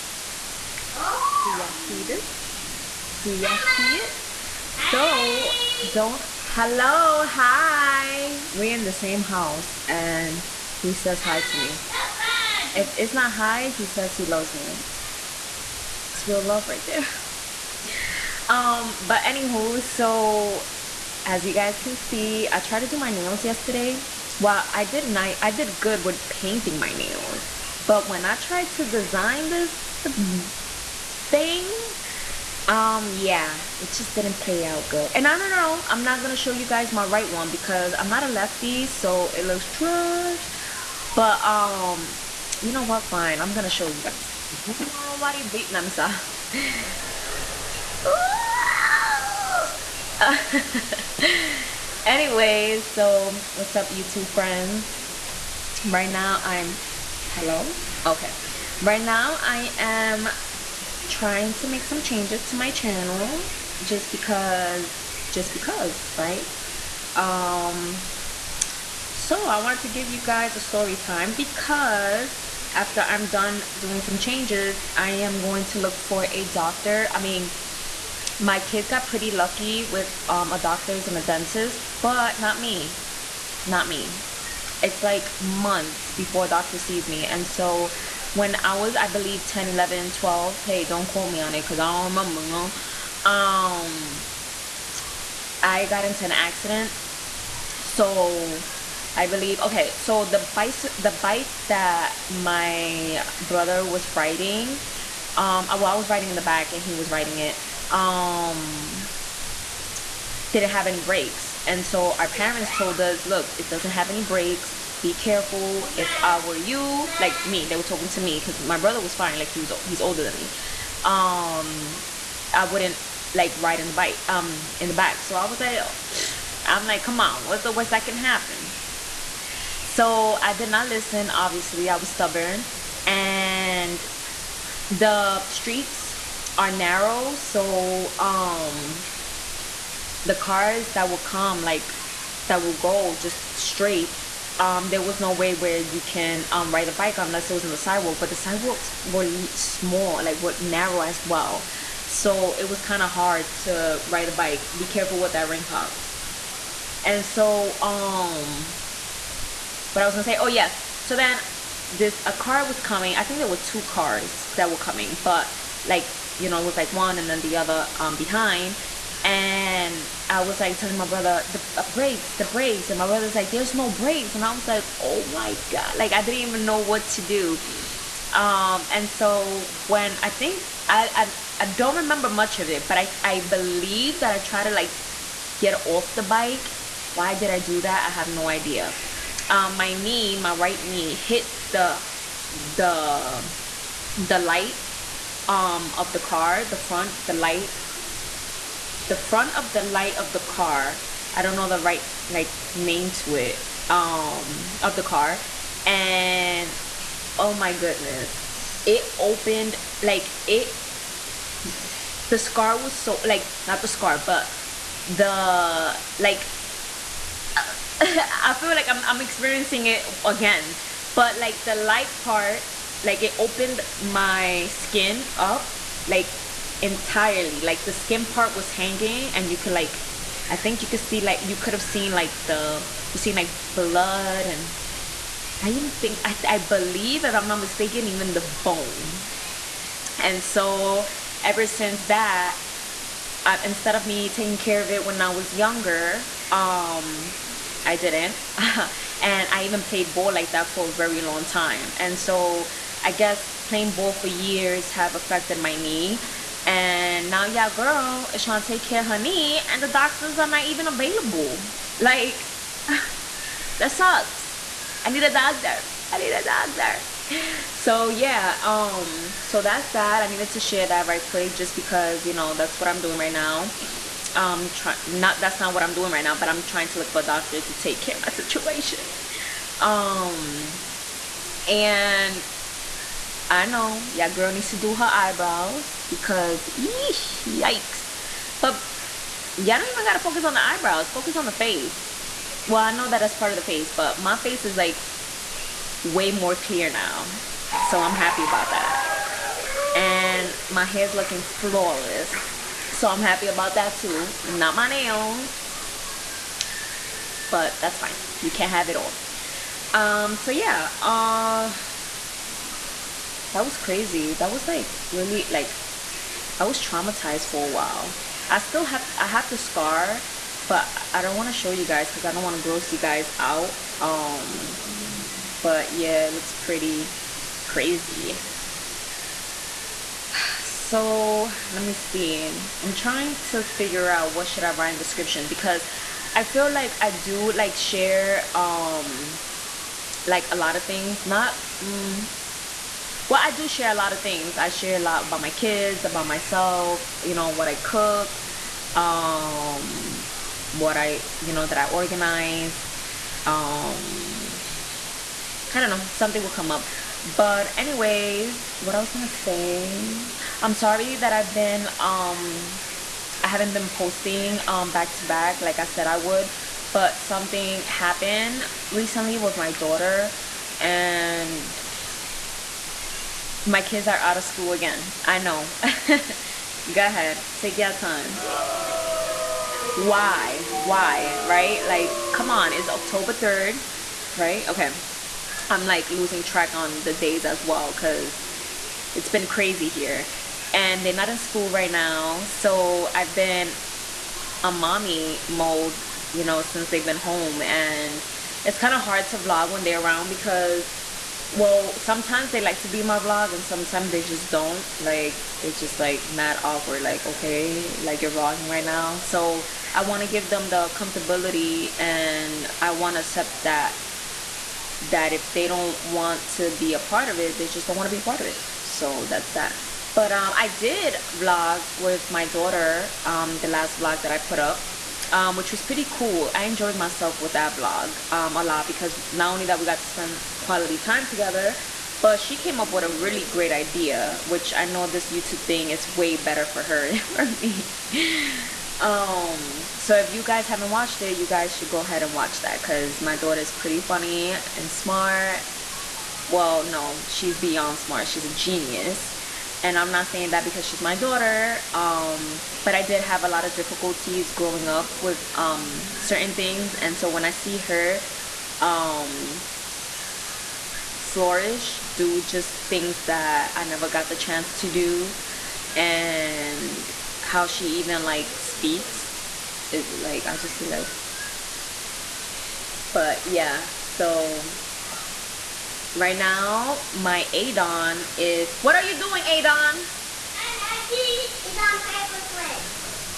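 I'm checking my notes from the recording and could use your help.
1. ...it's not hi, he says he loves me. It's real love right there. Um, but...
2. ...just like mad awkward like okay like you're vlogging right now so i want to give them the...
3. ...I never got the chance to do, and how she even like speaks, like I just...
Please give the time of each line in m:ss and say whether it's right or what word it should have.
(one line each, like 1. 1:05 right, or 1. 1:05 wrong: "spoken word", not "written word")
1. 0:12 right
2. 6:45 right
3. 7:43 right.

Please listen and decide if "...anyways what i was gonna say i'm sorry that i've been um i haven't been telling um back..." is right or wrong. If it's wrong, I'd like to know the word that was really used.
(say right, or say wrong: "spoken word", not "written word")
wrong: "posting", not "telling".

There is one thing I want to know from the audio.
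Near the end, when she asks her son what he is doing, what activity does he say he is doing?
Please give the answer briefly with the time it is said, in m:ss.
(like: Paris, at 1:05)
acting, at 8:01.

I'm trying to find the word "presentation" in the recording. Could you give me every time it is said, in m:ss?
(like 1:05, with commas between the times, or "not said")
not said.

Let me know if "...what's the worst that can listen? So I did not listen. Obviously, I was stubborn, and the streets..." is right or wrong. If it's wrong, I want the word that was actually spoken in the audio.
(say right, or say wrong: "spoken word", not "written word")
wrong: "happen", not "listen".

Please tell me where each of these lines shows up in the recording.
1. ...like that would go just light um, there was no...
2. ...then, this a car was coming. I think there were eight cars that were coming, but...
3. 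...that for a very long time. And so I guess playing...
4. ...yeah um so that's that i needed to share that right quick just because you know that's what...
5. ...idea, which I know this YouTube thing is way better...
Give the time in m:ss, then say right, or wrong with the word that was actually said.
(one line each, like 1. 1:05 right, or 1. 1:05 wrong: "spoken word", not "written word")
1. 2:21 wrong: "straight", not "light"
2. 2:41 wrong: "two", not "eight"
3. 4:10 right
4. 4:28 right
5. 7:13 right.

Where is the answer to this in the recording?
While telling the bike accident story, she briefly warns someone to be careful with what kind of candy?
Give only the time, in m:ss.
2:35.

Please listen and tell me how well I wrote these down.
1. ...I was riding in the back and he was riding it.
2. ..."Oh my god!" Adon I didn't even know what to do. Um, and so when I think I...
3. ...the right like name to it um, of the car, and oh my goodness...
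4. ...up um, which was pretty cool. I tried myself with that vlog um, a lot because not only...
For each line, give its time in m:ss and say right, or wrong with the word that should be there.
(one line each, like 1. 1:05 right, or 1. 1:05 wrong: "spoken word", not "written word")
1. 1:45 right
2. 2:55 wrong: "Like", not "Adon"
3. 3:21 right
4. 7:04 wrong: "enjoyed", not "tried".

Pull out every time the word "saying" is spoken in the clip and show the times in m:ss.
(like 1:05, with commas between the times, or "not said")
7:30.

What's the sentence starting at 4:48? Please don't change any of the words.
But y'all don't even gotta focus on the eyebrows.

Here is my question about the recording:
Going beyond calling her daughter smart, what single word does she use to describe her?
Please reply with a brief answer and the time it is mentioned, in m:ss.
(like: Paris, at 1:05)
genius, at 7:28.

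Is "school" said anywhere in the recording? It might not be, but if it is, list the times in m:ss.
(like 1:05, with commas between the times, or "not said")
6:14, 6:31.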